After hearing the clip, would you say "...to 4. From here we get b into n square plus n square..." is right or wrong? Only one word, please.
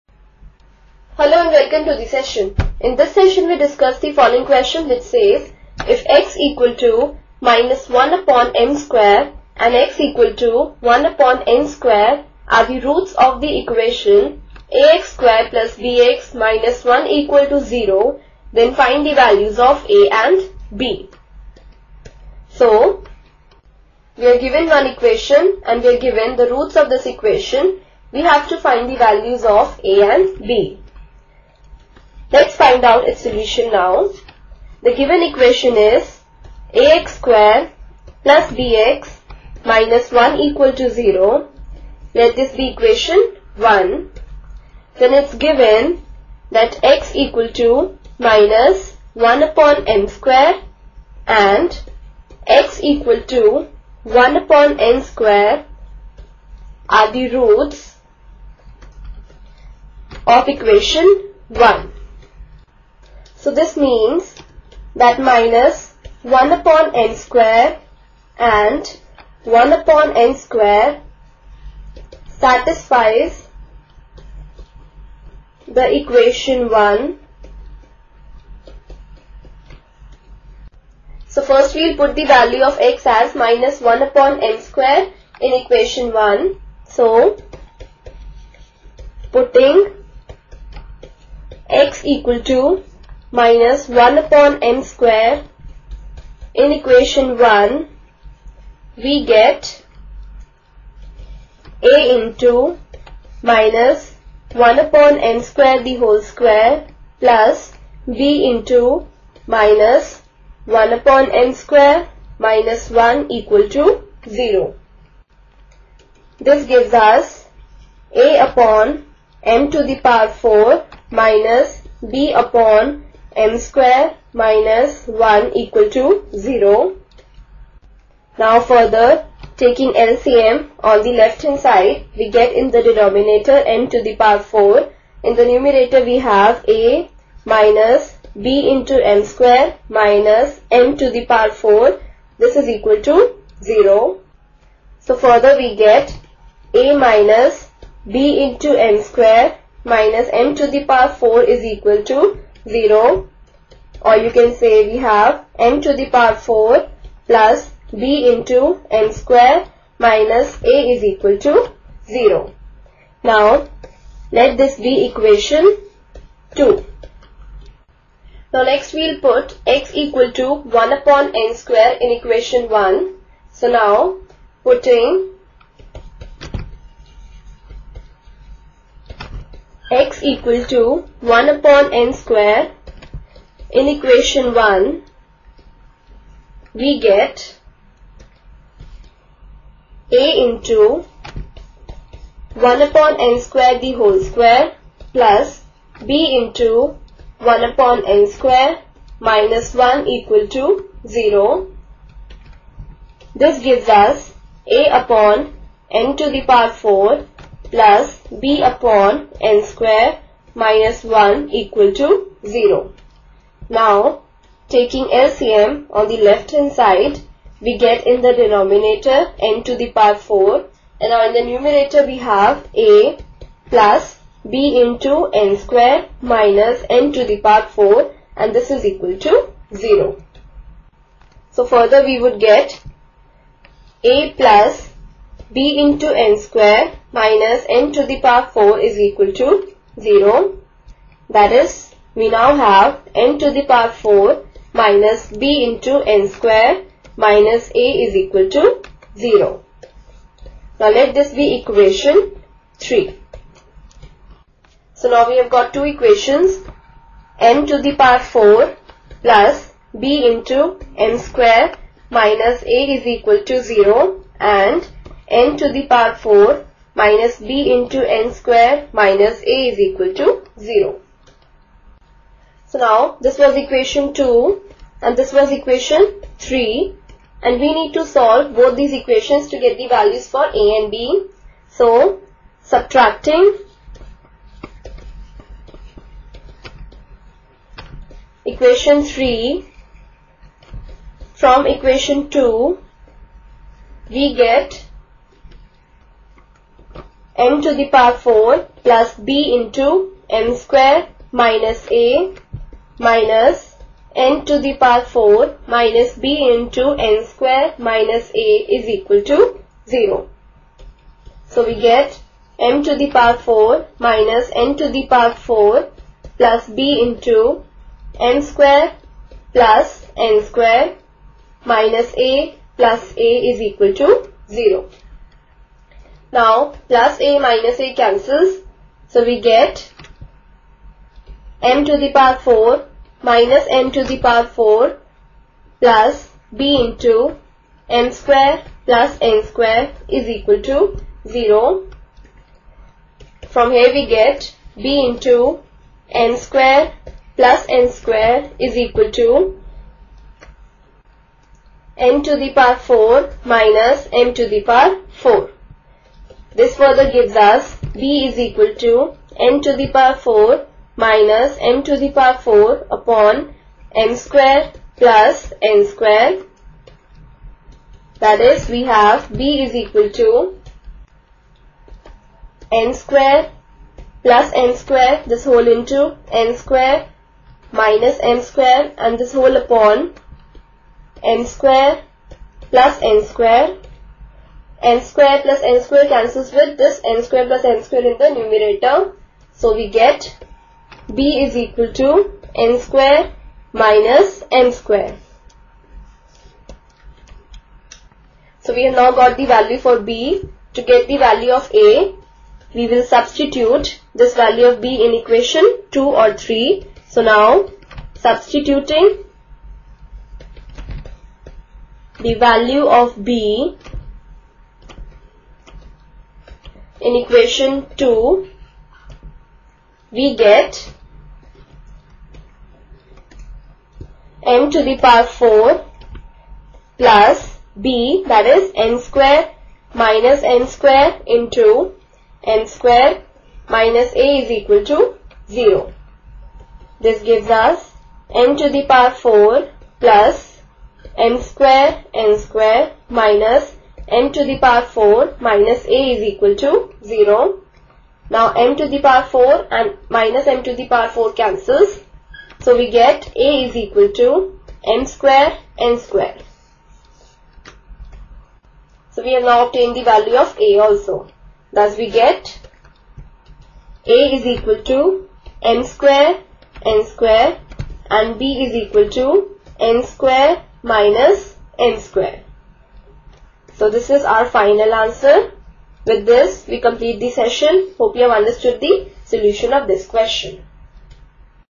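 wrong.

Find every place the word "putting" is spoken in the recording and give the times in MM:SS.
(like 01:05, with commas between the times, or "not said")
01:29, 02:54.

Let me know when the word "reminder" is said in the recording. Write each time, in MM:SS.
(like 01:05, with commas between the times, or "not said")
not said.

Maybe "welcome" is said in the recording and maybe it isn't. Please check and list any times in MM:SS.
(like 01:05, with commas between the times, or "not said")
00:01.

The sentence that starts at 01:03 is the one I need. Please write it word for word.
So this means that minus 1 upon n square and 1 upon n square satisfies the equation 1.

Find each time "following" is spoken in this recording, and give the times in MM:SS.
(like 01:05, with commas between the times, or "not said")
00:04.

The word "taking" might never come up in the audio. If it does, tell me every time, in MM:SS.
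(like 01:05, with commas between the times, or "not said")
02:09, 03:34.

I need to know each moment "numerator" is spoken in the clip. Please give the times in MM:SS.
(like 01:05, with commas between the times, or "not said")
02:15, 03:41, 06:28.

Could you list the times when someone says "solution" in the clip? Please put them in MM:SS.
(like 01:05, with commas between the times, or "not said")
00:33, 07:59.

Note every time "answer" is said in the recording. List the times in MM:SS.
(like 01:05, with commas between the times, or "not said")
07:54.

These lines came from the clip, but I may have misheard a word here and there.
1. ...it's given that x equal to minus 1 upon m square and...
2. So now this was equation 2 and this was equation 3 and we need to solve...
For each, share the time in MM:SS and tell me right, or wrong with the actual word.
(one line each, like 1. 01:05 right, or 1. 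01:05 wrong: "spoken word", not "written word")
1. 00:45 right
2. 04:32 right.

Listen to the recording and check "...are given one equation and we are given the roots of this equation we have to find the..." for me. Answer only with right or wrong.
right.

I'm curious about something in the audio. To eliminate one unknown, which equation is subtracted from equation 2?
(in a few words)
equation 3.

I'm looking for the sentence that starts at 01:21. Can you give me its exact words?
So first we'll put the value of x as minus 1 upon n square in equation 1.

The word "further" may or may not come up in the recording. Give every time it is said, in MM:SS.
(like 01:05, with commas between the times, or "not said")
02:08, 02:25, 03:51, 05:56.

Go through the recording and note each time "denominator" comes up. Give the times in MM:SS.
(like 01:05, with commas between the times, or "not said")
02:12, 03:38.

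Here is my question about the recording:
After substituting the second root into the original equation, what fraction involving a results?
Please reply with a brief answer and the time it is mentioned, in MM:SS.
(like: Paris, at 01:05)
a upon n to the power 4, at 03:24.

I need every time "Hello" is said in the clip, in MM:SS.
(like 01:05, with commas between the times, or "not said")
00:01.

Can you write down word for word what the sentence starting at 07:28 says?
Now m to the power 4 and minus m to the power 4 cancels.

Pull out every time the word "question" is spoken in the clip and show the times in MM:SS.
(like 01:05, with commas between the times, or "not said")
00:04, 08:00.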